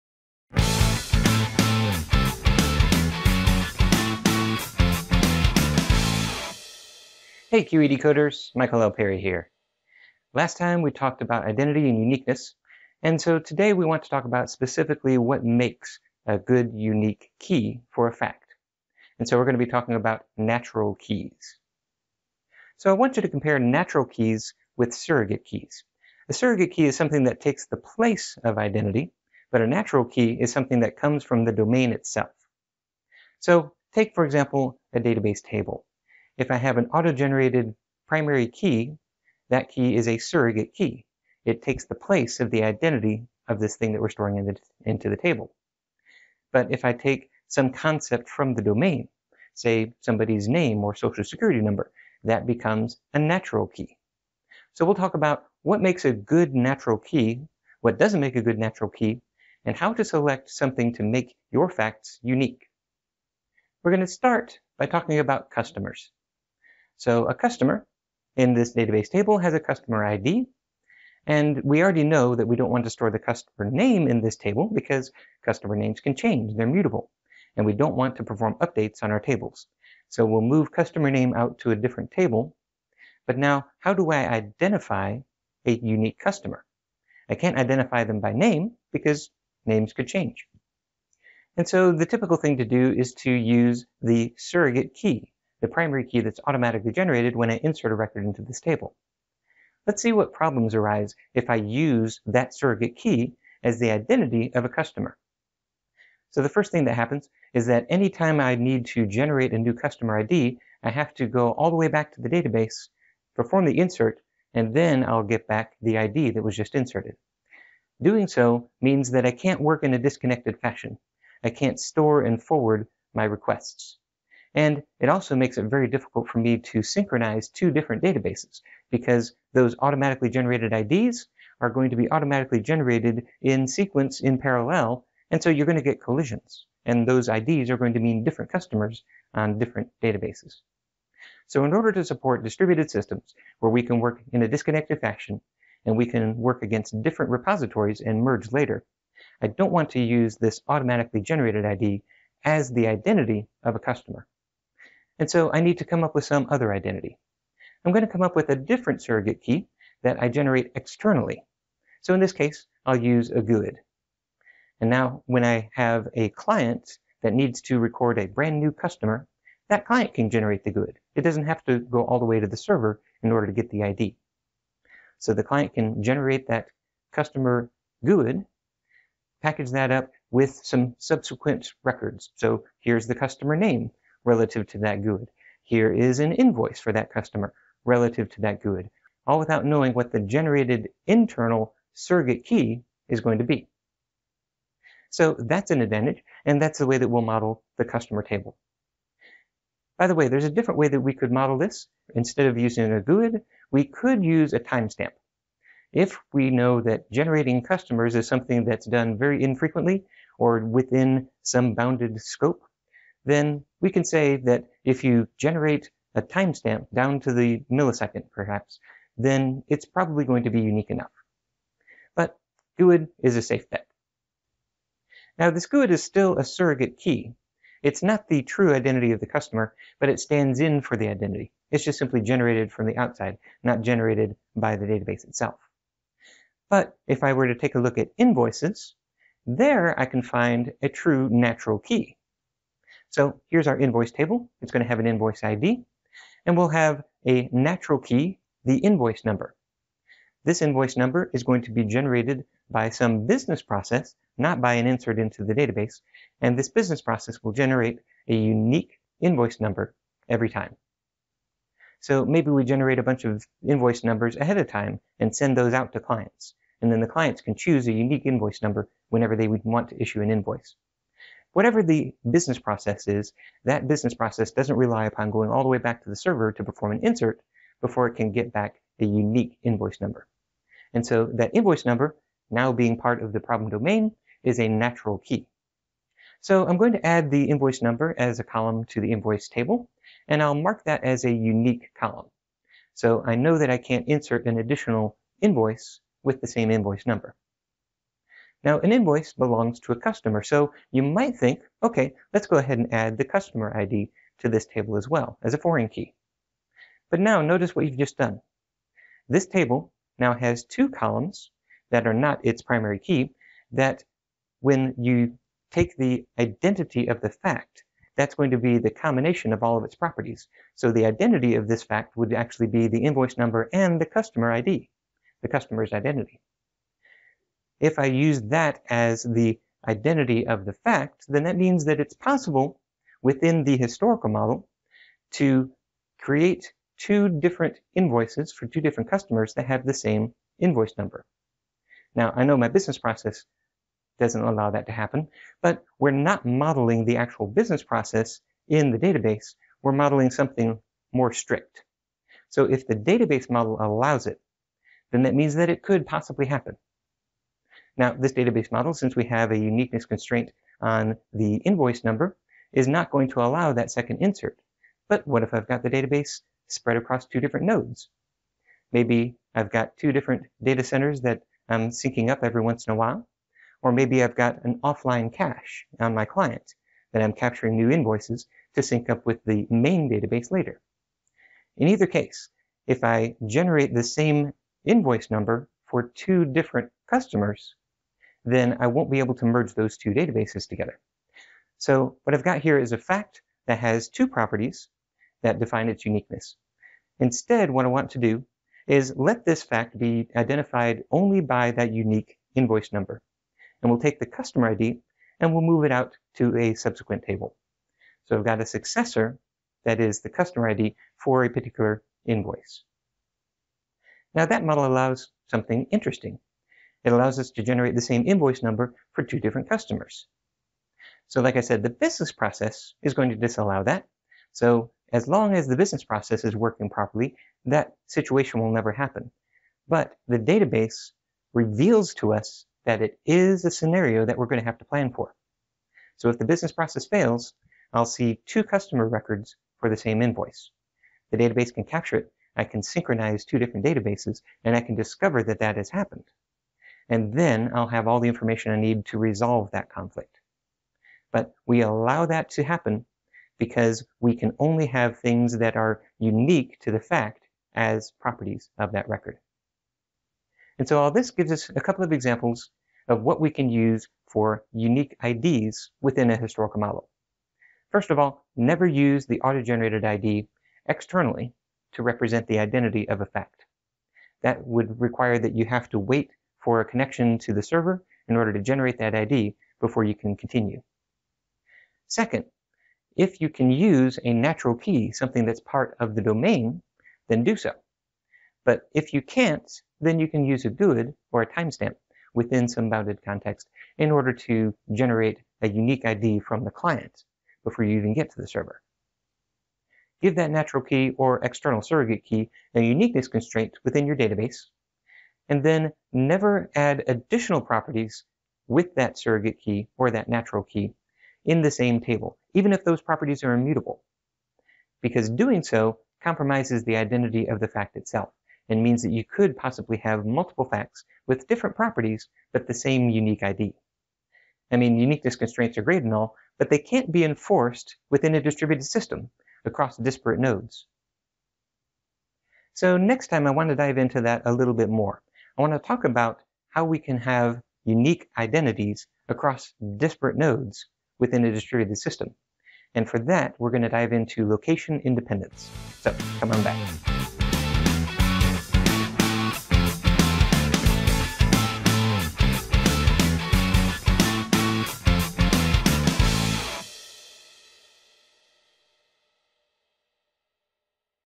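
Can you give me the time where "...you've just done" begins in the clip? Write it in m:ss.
5:07.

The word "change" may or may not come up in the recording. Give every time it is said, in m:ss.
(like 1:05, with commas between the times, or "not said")
1:16, 1:30.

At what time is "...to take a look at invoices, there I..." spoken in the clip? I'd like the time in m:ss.
3:57.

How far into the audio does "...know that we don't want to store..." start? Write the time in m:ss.
1:12.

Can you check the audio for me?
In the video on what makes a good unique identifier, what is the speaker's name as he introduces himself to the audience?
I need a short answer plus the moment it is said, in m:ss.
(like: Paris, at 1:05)
Michael L. Perry, at 0:08.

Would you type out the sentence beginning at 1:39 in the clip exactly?
Let's see what problems arise if I use that surrogate key as the identity of a customer.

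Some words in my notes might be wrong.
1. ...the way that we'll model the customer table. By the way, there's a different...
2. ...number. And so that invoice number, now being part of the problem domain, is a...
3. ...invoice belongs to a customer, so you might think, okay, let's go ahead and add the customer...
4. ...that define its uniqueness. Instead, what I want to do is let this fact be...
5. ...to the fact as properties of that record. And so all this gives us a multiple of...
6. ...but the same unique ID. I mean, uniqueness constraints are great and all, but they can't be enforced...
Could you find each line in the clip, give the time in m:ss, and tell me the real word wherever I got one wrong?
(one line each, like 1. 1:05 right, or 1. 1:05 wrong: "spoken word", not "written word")
1. 3:16 right
2. 4:39 right
3. 4:58 right
4. 6:35 right
5. 7:36 wrong: "couple", not "multiple"
6. 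8:42 right.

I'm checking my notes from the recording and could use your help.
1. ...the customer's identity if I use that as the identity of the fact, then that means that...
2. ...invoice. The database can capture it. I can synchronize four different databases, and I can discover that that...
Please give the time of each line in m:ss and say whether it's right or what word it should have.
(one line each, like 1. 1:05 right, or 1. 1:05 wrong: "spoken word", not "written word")
1. 5:25 right
2. 7:20 wrong: "two", not "four".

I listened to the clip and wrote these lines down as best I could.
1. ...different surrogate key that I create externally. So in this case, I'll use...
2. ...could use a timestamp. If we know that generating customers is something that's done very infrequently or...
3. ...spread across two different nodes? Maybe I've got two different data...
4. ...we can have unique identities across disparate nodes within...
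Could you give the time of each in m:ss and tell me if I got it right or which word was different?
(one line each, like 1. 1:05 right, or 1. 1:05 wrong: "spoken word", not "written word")
1. 2:38 wrong: "generate", not "create"
2. 3:23 right
3. 6:06 right
4. 8:56 right.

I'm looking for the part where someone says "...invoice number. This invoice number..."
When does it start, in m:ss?
4:08.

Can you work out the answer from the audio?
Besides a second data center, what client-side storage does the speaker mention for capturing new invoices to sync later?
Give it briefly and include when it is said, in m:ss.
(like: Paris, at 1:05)
offline cache, at 6:14.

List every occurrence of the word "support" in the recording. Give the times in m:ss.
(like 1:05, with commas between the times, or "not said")
2:22.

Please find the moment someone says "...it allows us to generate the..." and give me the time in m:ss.
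6:57.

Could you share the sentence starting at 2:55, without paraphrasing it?
So the client can generate that customer GUID, package that up with some subsequent records.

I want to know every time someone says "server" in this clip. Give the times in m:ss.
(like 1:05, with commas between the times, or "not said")
2:52, 4:36, 7:57, 8:18.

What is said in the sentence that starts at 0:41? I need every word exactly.
It takes the place of the identity of this thing that we're storing in the, into the table.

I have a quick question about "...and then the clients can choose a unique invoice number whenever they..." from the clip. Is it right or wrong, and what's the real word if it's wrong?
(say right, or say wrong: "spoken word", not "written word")
right.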